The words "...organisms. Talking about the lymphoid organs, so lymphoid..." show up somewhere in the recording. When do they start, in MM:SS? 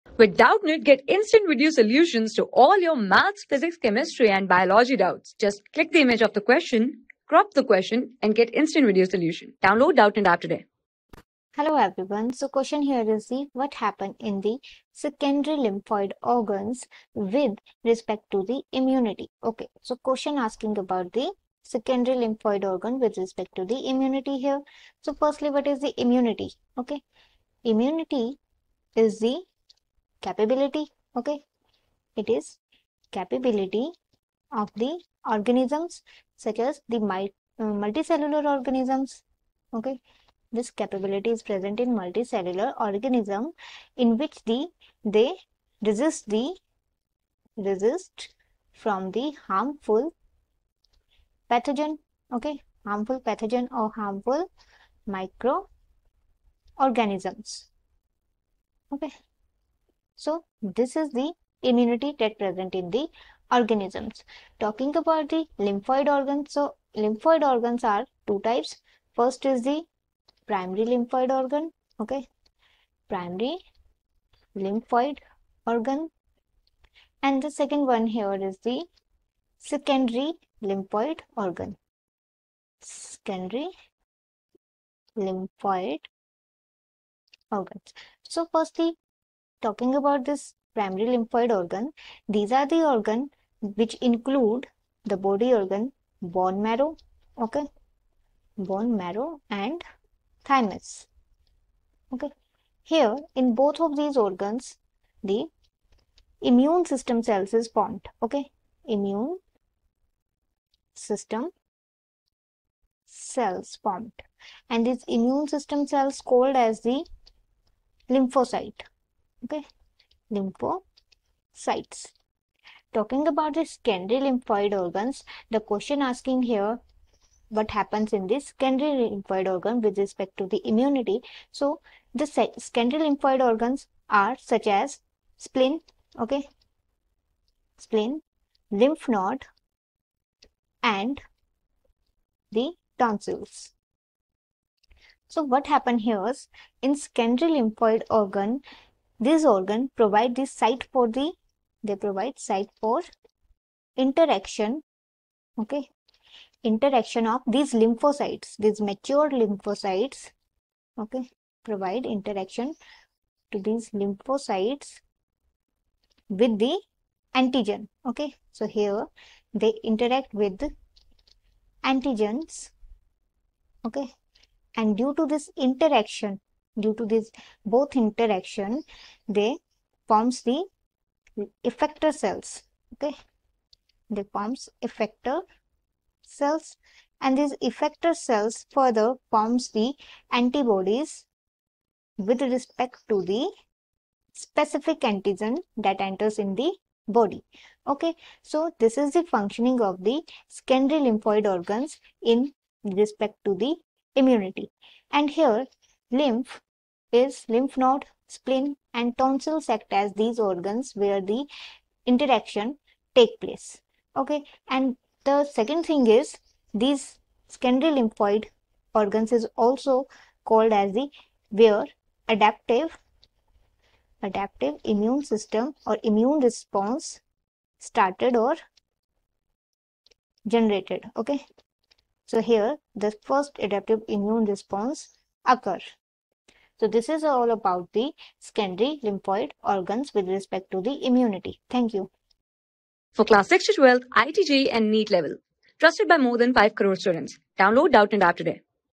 01:03.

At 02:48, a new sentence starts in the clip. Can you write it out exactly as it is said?
So, here they interact with antigens, okay, and due to this interaction, Due to this both interaction, they forms the effector cells.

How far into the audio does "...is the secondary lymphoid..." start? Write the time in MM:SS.
01:18.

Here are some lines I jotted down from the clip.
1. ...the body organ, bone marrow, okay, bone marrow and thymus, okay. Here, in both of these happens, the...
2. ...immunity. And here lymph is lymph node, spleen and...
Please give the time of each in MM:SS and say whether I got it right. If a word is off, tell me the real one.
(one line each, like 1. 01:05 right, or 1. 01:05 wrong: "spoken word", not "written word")
1. 01:35 wrong: "organs", not "happens"
2. 03:24 right.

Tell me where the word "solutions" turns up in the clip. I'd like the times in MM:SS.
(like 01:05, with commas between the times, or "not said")
00:01, 00:09.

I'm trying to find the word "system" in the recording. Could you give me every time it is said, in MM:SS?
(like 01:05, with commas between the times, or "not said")
01:46, 01:50, 01:55, 03:45.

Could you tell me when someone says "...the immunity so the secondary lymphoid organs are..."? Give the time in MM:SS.
02:10.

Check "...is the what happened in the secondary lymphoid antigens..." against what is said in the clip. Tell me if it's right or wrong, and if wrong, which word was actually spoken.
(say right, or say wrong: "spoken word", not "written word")
wrong: "organs", not "antigens".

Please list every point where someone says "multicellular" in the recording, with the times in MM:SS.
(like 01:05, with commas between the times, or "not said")
00:37, 00:42.